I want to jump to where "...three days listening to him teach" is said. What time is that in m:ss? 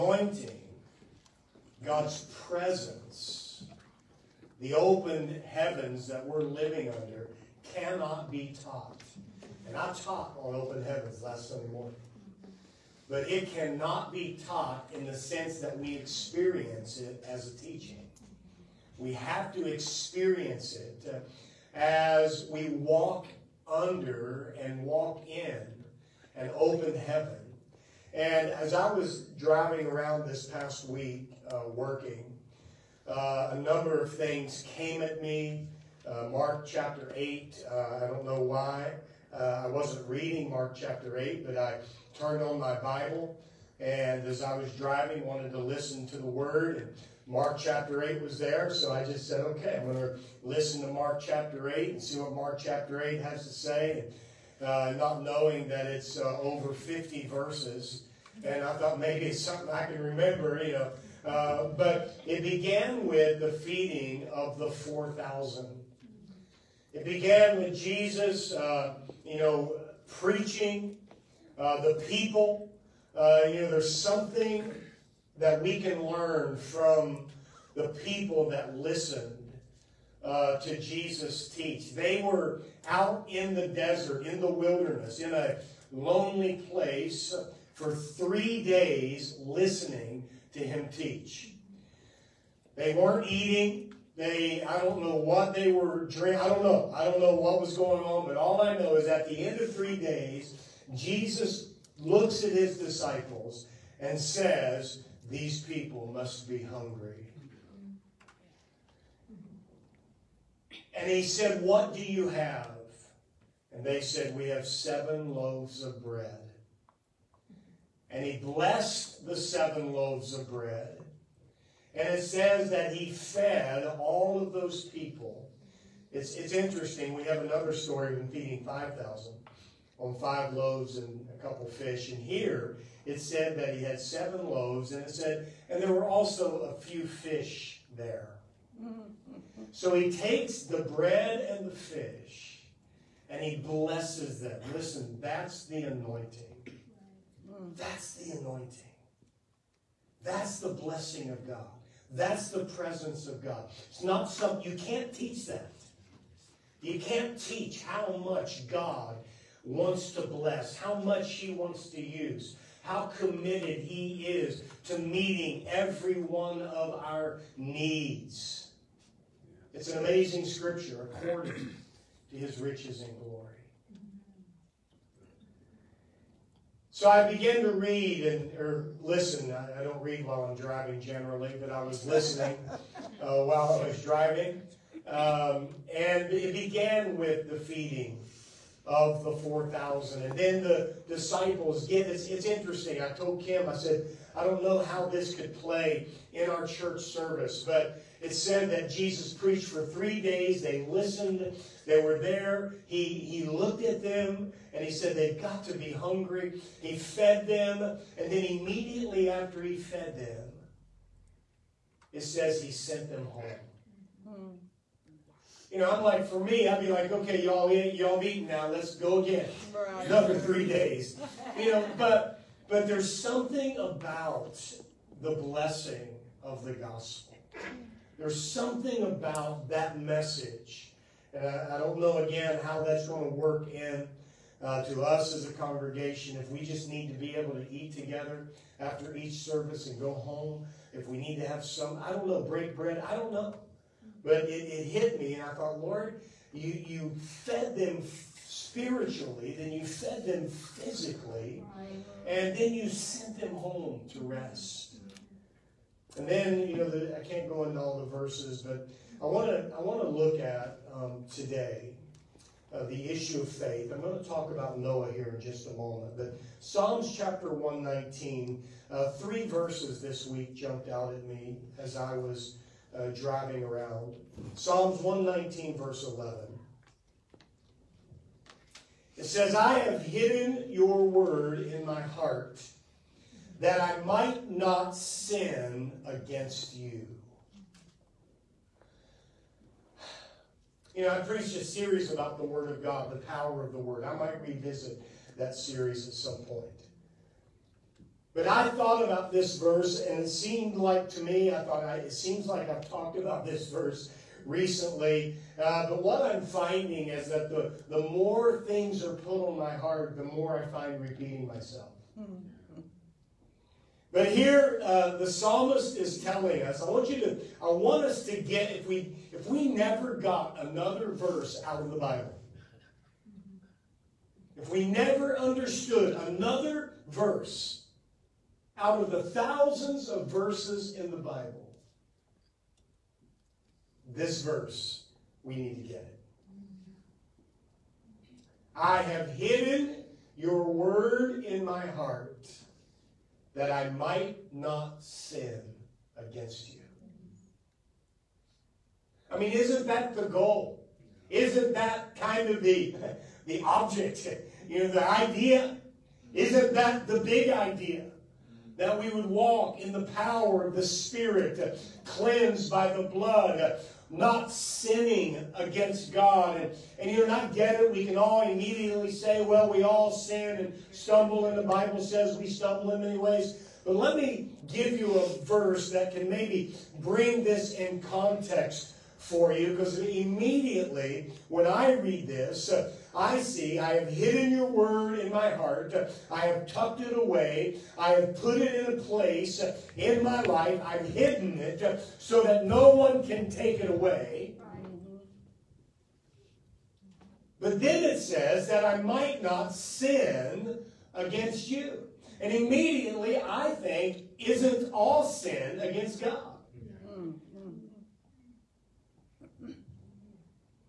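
1:27.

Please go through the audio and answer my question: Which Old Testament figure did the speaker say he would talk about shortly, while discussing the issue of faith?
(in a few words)
Noah.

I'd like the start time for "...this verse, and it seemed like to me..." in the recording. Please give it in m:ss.
4:59.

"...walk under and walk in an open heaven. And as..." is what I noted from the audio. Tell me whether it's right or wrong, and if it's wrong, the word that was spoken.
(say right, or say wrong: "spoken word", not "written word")
right.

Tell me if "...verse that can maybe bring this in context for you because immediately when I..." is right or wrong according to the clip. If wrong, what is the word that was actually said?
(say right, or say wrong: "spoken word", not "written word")
right.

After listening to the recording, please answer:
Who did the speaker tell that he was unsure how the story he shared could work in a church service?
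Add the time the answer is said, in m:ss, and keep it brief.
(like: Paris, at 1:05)
Kim, at 3:13.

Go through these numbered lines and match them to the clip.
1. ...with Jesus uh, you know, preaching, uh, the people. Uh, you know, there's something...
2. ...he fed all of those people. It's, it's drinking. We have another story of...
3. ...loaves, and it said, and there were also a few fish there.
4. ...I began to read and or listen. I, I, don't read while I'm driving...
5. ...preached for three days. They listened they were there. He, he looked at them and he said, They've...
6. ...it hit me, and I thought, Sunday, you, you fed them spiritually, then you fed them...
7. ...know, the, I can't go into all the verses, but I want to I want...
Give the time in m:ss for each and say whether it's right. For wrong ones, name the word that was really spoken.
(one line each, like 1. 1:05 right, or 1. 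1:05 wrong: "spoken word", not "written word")
1. 1:07 right
2. 2:02 wrong: "interesting", not "drinking"
3. 2:14 right
4. 2:57 right
5. 3:19 right
6. 4:04 wrong: "Lord", not "Sunday"
7. 4:16 right.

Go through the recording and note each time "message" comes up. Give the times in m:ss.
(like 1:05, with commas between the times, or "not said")
3:49.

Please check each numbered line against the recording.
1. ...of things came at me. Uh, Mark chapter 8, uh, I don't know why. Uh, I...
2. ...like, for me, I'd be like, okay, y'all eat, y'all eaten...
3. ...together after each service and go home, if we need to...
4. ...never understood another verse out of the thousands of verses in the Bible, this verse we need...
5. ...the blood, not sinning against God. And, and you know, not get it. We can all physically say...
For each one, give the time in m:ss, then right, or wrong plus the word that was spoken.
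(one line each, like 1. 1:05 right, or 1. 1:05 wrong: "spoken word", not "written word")
1. 0:34 right
2. 3:36 right
3. 3:57 right
4. 5:24 right
5. 6:02 wrong: "immediately", not "physically".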